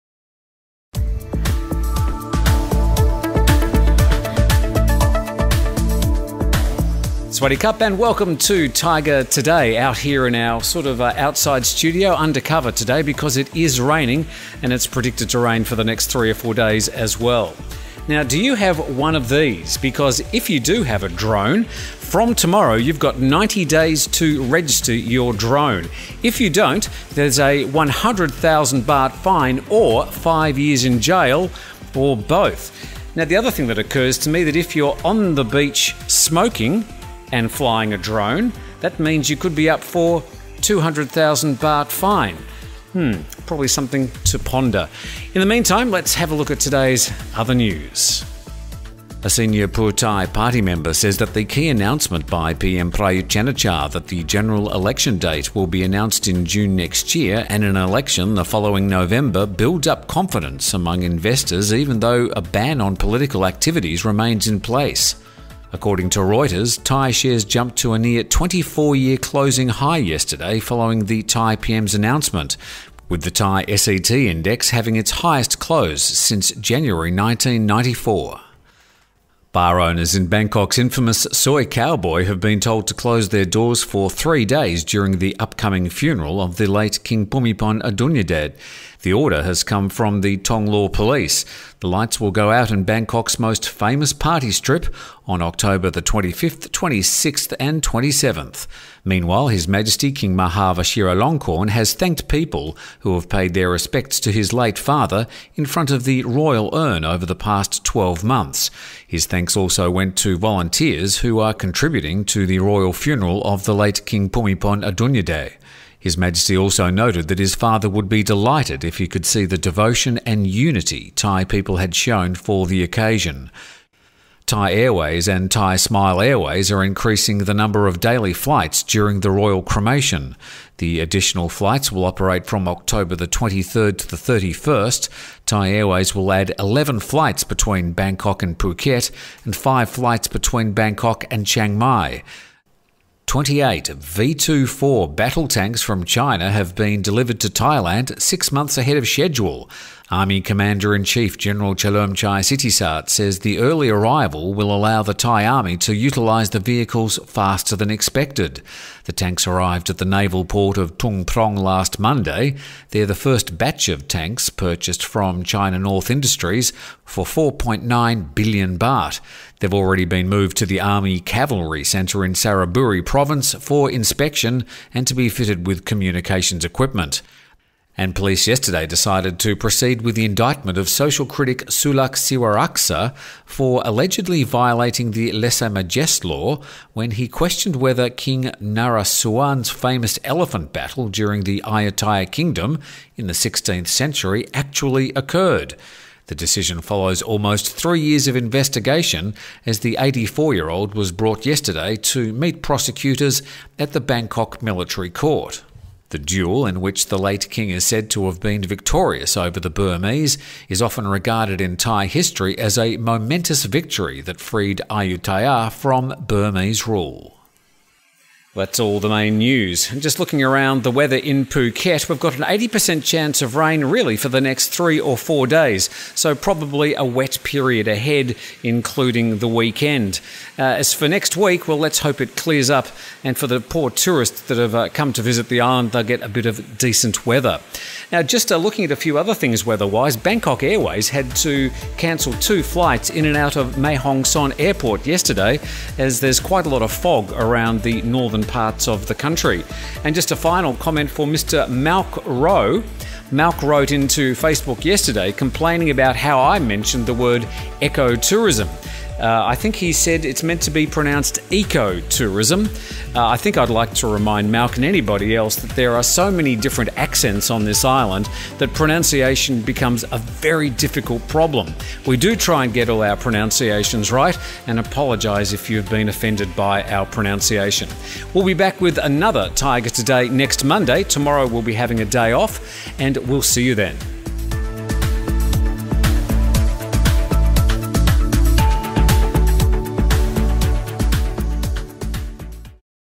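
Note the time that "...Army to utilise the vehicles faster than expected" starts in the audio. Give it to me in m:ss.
2:35.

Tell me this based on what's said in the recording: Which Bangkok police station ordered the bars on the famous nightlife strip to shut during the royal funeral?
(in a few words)
Thong Lo Police.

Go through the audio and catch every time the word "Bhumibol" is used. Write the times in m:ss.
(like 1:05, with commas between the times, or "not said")
1:27, 1:54.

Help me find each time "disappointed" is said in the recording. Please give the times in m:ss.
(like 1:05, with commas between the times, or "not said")
not said.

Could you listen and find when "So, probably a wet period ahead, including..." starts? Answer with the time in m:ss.
3:46.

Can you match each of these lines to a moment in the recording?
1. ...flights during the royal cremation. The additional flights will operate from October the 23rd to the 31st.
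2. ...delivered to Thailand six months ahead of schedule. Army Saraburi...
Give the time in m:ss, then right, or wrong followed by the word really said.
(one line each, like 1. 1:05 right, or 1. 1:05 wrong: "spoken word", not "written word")
1. 2:08 right
2. 2:27 wrong: "Commander", not "Saraburi".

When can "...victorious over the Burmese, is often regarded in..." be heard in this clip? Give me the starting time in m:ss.
3:28.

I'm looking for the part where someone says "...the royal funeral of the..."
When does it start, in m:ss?
1:52.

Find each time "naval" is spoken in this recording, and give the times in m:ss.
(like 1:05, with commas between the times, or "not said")
2:40.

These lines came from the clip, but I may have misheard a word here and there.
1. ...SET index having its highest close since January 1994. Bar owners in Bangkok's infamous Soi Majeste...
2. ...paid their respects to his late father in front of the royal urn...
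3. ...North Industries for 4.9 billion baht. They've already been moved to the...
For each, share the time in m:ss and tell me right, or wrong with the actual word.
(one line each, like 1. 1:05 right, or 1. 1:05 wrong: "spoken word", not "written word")
1. 1:13 wrong: "Cowboy", not "Majeste"
2. 1:43 right
3. 2:45 right.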